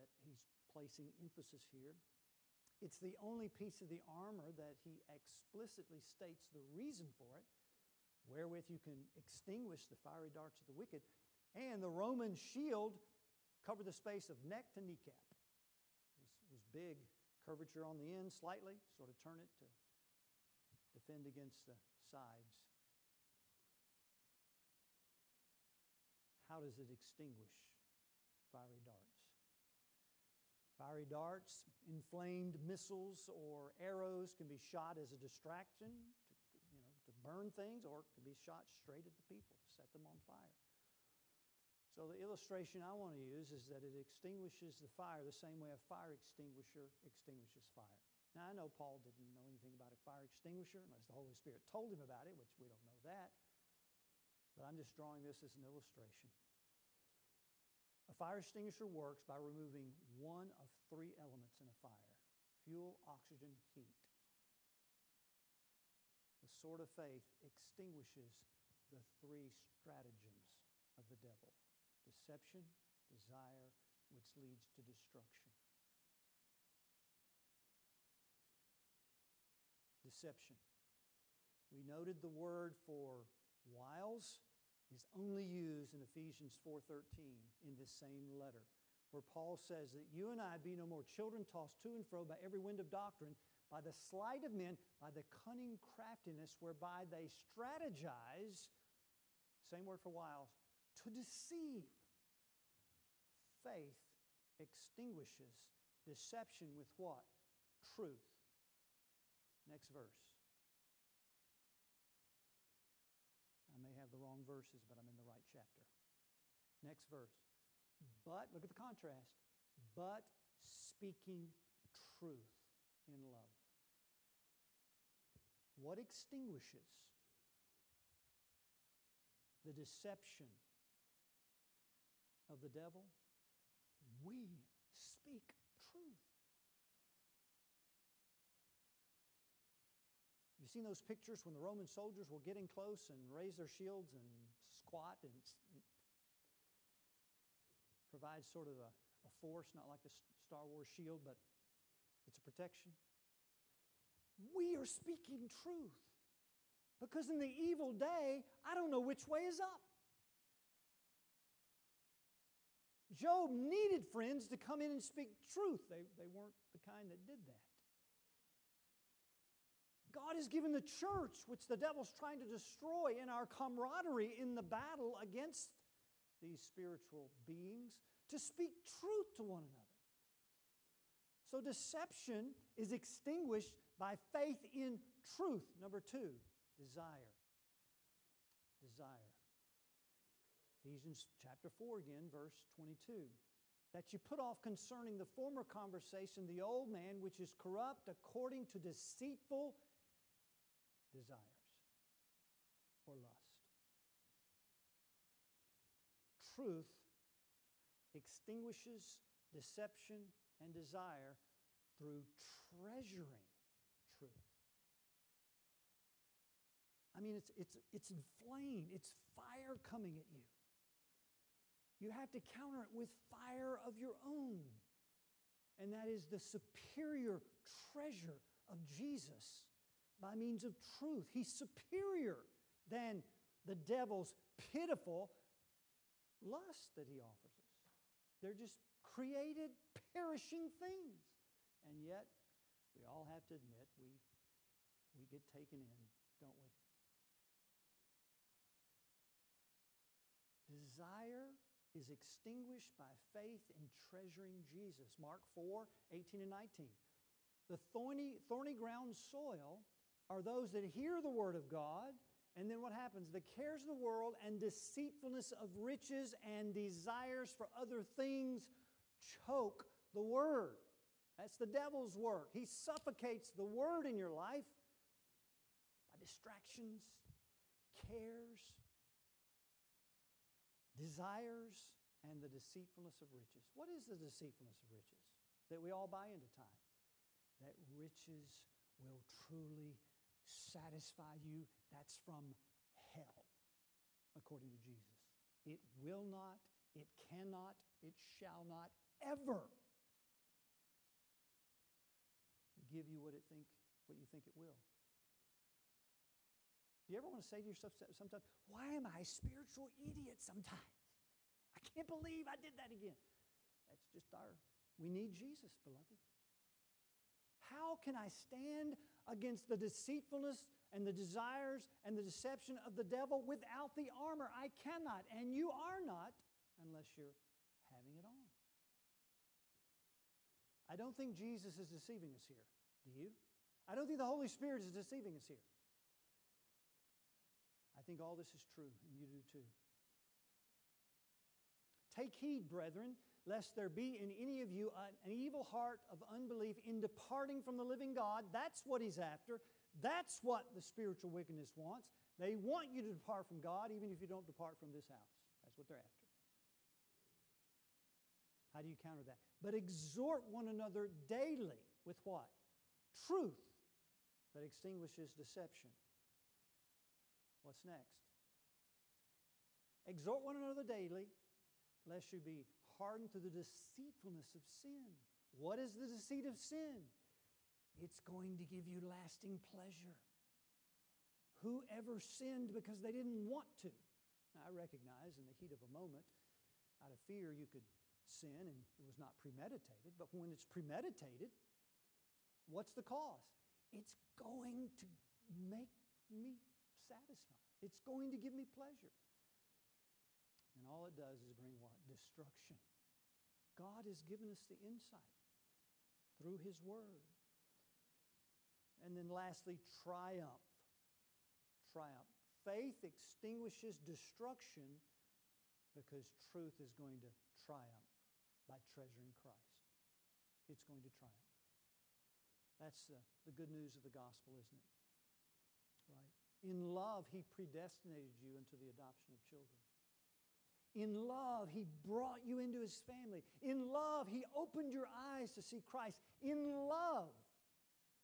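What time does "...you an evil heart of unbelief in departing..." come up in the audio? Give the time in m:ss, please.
5:44.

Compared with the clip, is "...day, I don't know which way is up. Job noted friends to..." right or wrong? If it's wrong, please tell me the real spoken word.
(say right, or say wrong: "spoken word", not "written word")
wrong: "needed", not "noted".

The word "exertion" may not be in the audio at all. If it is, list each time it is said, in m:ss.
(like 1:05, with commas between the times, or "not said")
not said.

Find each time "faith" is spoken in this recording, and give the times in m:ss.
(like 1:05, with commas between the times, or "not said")
1:06, 1:43, 3:04, 4:13, 6:52.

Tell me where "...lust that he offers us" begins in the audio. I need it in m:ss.
3:56.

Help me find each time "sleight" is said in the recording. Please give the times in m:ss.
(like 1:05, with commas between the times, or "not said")
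1:33.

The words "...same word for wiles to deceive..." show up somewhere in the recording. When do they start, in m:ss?
1:39.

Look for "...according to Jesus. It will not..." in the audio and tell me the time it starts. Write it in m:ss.
4:54.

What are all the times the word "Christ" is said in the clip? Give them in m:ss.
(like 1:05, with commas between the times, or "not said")
6:59, 7:15.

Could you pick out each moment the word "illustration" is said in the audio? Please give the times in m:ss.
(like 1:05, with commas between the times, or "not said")
0:42, 0:55.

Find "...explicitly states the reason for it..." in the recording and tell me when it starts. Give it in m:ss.
0:05.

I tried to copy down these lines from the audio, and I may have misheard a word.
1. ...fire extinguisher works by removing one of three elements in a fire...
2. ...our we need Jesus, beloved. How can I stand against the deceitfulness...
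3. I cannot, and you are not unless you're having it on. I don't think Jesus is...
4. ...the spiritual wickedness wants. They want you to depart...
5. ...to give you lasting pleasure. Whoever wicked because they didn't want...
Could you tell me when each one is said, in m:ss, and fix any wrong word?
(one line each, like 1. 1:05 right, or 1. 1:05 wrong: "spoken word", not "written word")
1. 0:58 right
2. 5:14 right
3. 5:24 right
4. 5:50 right
5. 6:18 wrong: "sinned", not "wicked".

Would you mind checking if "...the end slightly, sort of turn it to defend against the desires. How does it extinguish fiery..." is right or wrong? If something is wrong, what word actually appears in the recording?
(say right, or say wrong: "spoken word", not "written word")
wrong: "sides", not "desires".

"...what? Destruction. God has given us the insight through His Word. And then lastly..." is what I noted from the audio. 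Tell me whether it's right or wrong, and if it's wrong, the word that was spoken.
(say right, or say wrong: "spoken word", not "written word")
right.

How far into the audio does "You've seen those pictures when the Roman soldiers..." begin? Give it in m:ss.
2:20.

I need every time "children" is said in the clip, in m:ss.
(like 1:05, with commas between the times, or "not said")
1:31, 7:09.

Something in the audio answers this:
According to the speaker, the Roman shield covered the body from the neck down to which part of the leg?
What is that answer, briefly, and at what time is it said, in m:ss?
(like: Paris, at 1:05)
Kneecap, at 0:14.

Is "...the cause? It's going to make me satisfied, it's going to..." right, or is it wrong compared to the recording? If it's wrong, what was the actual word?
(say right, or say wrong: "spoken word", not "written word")
right.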